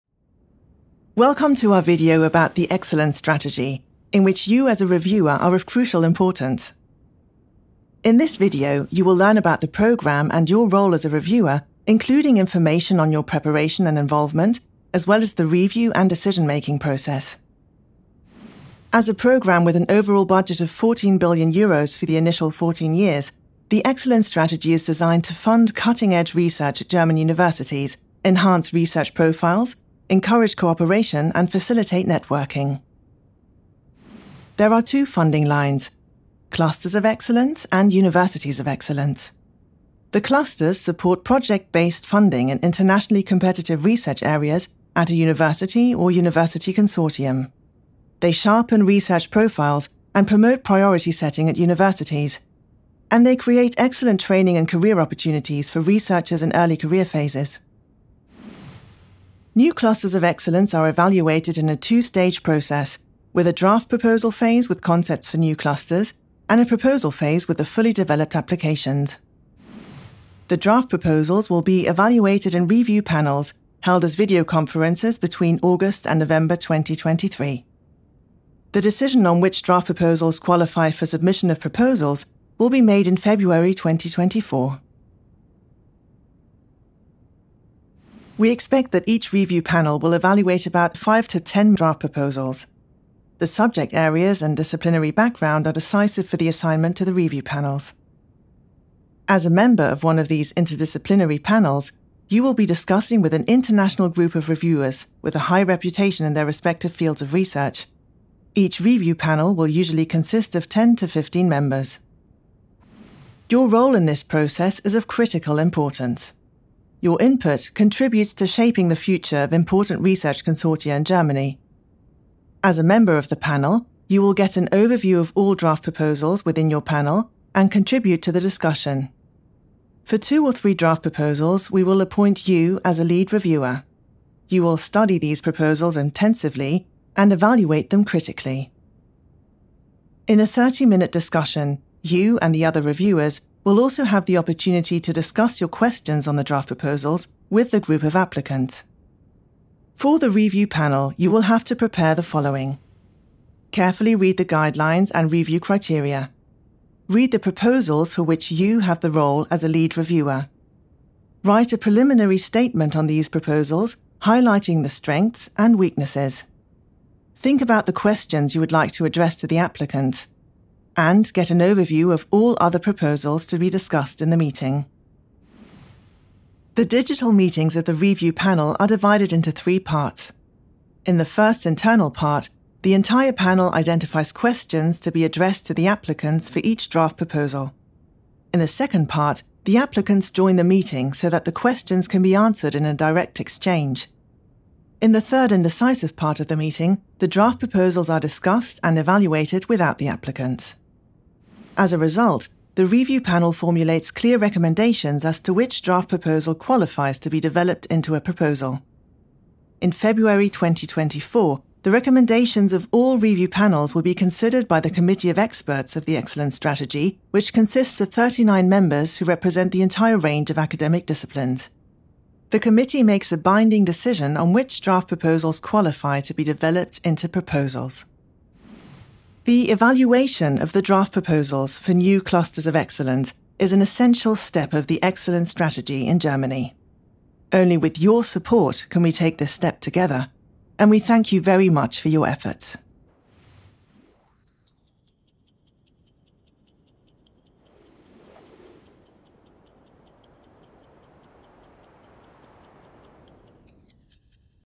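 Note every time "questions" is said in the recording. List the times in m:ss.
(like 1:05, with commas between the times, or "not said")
2:25, 2:47, 3:04, 3:11.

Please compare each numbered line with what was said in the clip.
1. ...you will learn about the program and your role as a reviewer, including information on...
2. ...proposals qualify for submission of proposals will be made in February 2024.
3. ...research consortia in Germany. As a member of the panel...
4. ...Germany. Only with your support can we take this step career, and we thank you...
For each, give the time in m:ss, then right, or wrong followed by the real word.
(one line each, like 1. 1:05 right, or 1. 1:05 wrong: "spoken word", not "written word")
1. 0:08 right
2. 1:19 right
3. 2:00 right
4. 3:56 wrong: "together", not "career".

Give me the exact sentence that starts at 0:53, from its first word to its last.
And they create excellent training and career opportunities for researchers in early career phases.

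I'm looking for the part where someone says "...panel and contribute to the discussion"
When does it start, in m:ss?
2:06.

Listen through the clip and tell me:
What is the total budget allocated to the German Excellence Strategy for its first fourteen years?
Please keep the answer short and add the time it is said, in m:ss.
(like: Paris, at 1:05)
14 billion euros, at 0:20.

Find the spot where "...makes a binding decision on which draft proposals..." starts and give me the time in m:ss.
3:43.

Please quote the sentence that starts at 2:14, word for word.
You will study these proposals intensively and evaluate them critically.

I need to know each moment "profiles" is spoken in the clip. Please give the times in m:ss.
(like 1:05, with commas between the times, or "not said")
0:29, 0:49.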